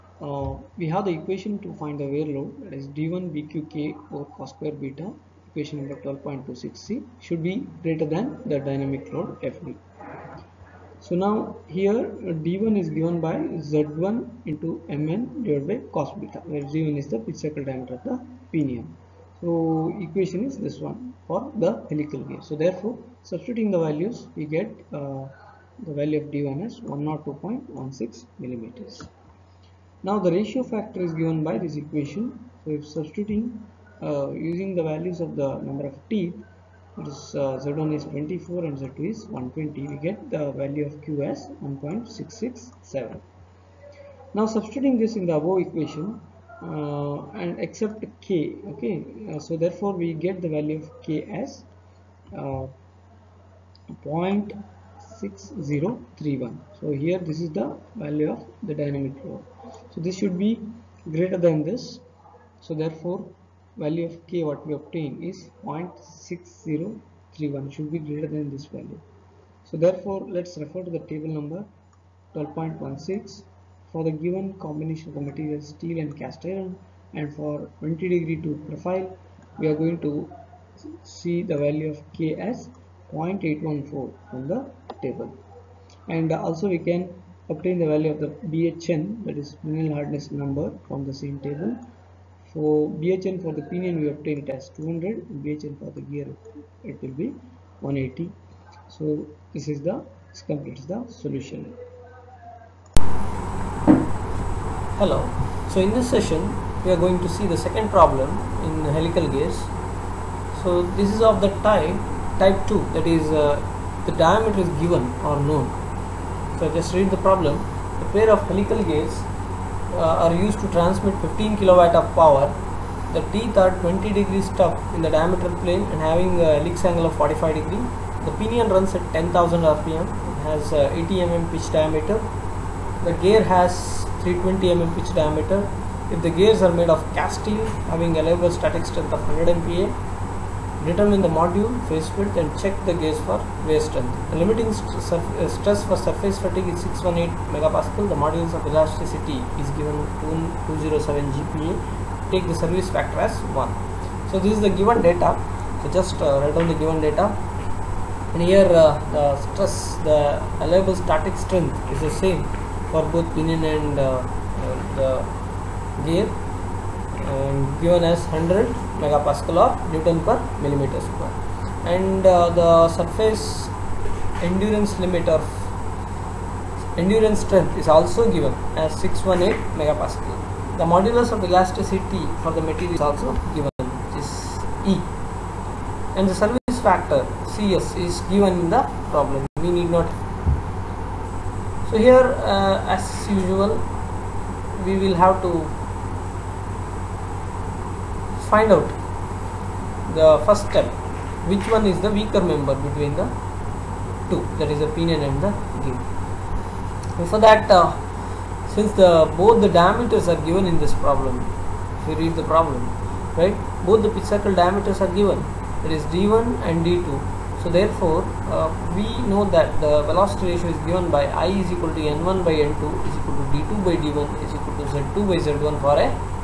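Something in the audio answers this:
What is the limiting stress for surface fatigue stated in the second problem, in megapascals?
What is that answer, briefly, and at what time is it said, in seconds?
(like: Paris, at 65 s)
618 MPa, at 146 s.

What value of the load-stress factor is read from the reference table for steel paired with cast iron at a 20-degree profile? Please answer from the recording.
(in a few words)
0.814.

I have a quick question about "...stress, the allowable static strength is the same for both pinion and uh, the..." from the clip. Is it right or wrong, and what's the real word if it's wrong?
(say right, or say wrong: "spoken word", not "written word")
right.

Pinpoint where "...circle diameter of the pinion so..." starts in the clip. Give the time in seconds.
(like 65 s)
17 s.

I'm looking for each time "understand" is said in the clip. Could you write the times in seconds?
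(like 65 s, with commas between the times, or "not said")
not said.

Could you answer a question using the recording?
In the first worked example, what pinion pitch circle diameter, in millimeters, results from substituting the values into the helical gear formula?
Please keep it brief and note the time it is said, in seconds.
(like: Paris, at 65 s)
102.16 mm, at 26 s.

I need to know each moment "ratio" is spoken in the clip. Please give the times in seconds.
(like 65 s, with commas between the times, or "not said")
30 s, 220 s.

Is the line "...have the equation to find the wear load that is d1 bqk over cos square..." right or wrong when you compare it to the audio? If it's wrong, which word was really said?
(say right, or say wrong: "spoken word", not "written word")
right.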